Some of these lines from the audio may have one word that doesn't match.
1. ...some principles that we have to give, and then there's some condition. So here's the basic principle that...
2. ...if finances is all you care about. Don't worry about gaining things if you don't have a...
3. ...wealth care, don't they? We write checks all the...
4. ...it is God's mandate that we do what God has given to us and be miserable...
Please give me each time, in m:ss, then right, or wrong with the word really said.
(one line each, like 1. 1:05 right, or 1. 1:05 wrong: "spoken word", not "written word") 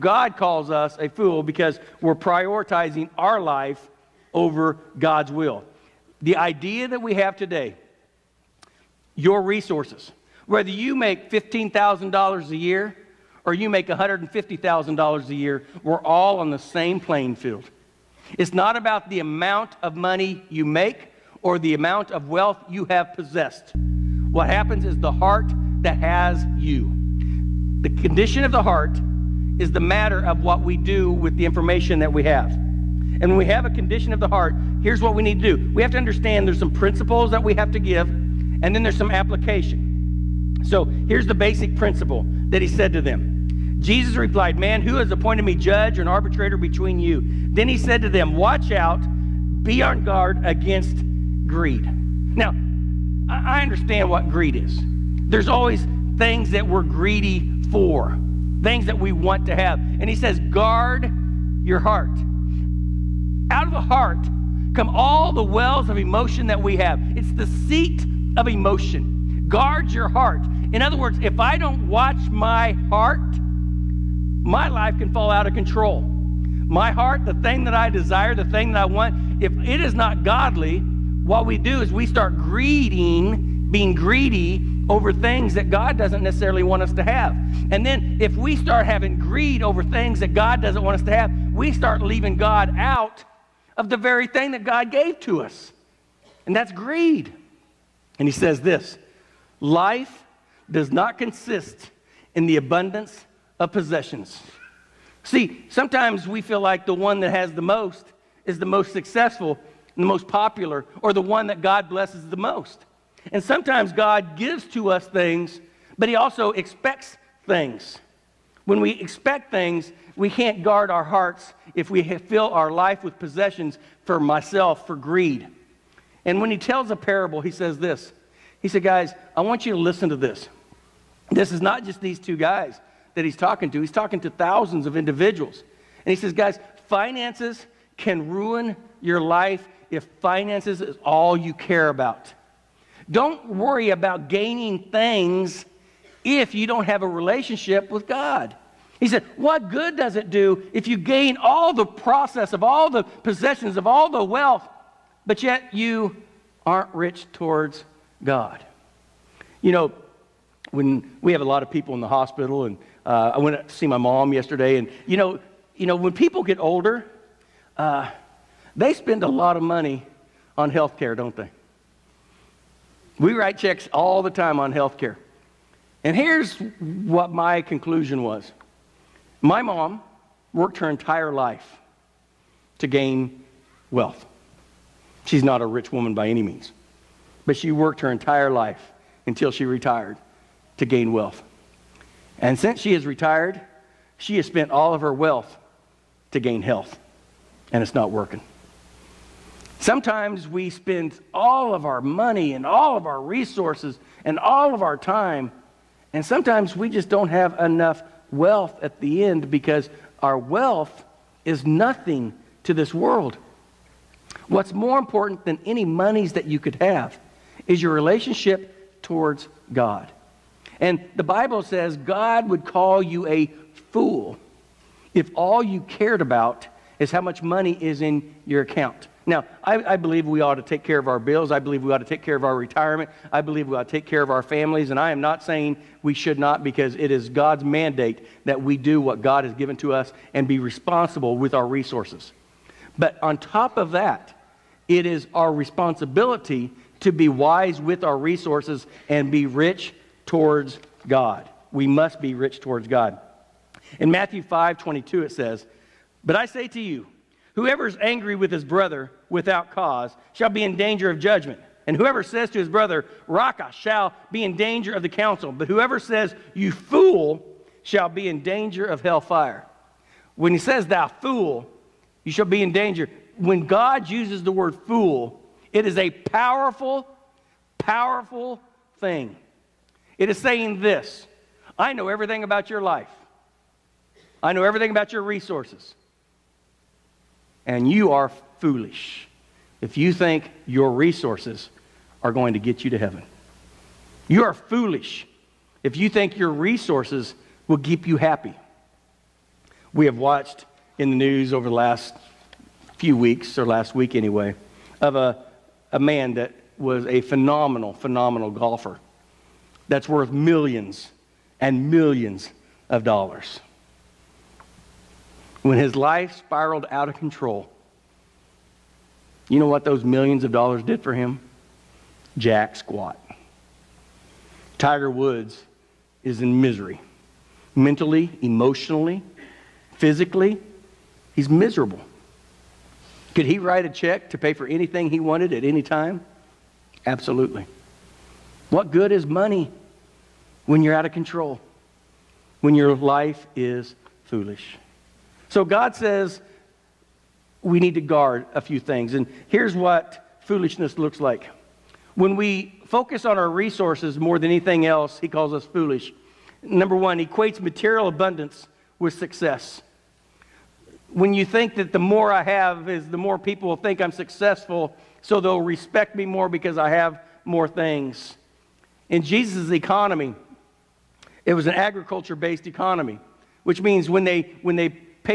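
1. 0:36 wrong: "application", not "condition"
2. 2:19 right
3. 2:50 wrong: "health", not "wealth"
4. 3:56 wrong: "responsible", not "miserable".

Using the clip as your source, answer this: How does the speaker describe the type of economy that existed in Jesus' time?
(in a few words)
agriculture based.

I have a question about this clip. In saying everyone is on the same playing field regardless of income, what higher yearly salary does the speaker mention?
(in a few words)
$150,000.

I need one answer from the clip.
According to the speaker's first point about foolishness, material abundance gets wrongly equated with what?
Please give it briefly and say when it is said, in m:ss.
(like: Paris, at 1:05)
success, at 5:59.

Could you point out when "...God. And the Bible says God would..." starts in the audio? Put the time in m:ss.
3:39.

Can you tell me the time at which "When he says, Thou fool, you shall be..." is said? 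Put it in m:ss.
4:30.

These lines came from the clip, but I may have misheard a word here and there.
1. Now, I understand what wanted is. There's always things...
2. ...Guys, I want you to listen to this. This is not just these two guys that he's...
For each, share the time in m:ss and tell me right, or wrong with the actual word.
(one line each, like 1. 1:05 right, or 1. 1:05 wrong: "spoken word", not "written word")
1. 0:52 wrong: "greed", not "wanted"
2. 2:08 right.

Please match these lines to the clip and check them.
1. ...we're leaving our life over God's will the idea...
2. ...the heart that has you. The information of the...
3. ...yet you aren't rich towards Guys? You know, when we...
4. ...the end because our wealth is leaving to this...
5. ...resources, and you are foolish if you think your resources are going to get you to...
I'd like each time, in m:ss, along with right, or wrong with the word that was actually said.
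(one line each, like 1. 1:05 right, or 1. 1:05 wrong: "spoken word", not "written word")
1. 0:02 wrong: "prioritizing", not "leaving"
2. 0:24 wrong: "condition", not "information"
3. 2:35 wrong: "God", not "Guys"
4. 3:29 wrong: "nothing", not "leaving"
5. 4:45 right.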